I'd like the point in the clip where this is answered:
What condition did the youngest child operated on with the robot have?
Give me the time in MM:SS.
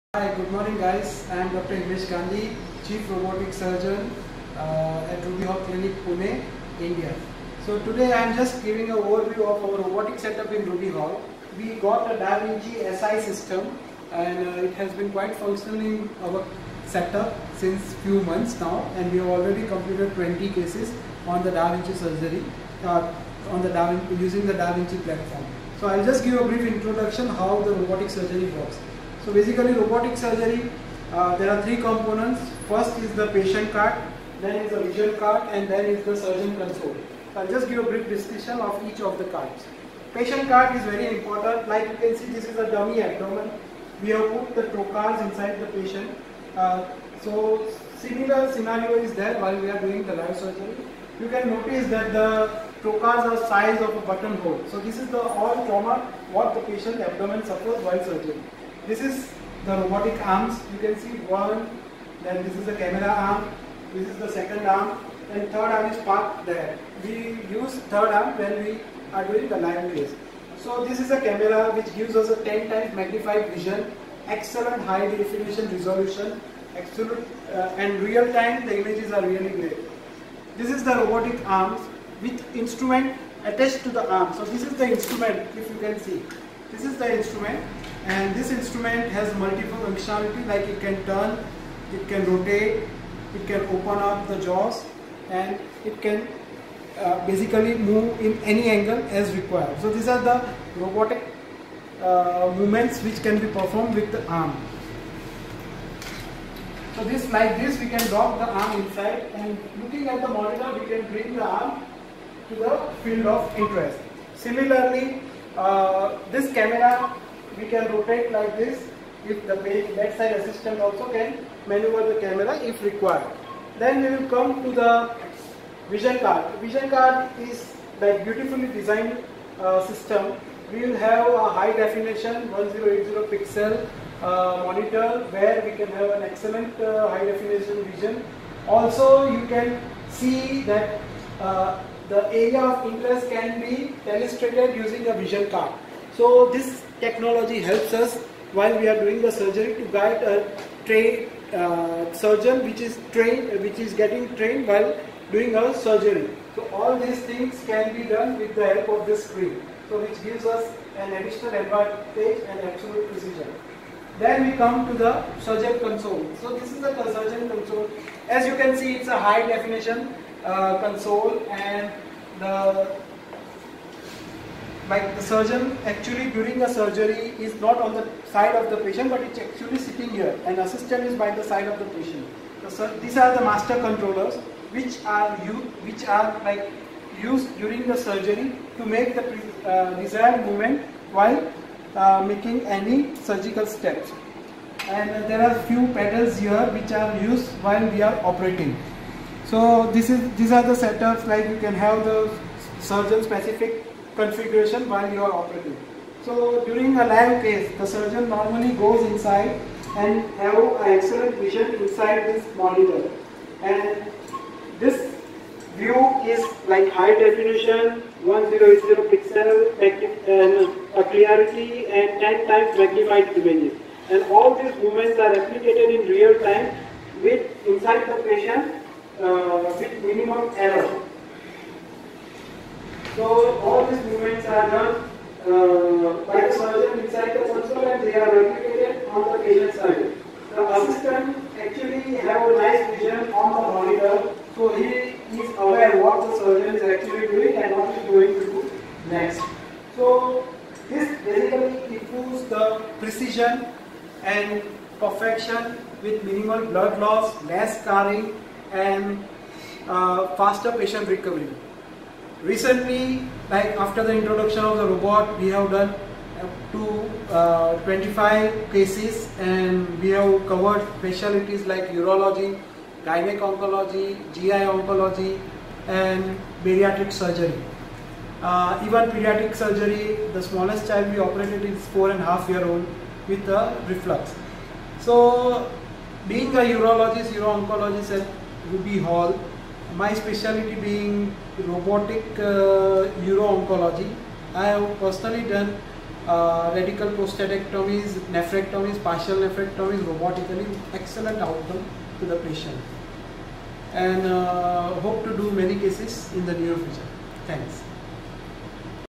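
04:43.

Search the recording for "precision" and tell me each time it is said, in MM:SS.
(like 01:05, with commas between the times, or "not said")
02:43, 04:12.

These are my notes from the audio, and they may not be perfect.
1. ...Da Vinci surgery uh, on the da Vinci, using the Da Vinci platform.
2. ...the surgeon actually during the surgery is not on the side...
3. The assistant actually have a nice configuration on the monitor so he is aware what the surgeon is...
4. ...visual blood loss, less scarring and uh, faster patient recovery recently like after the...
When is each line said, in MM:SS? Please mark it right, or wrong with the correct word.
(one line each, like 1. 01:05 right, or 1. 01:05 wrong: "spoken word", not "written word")
1. 00:21 right
2. 02:55 right
3. 04:00 wrong: "vision", not "configuration"
4. 04:16 wrong: "minimal", not "visual".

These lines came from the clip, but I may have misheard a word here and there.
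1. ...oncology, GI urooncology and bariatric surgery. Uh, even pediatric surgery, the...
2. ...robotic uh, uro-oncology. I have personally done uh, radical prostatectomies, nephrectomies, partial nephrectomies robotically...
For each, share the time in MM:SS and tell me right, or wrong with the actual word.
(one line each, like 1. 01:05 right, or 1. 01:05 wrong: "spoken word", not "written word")
1. 04:33 wrong: "oncology", not "urooncology"
2. 04:51 right.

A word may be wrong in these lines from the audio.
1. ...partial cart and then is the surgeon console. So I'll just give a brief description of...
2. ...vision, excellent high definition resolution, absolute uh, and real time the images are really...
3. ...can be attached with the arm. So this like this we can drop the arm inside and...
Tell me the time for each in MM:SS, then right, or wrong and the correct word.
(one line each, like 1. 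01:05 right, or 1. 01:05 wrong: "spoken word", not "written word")
1. 00:34 wrong: "visual", not "partial"
2. 01:13 right
3. 01:43 wrong: "performed", not "attached".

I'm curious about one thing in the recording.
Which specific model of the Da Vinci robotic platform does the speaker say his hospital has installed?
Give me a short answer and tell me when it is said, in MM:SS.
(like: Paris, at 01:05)
Da Vinci SI, at 00:12.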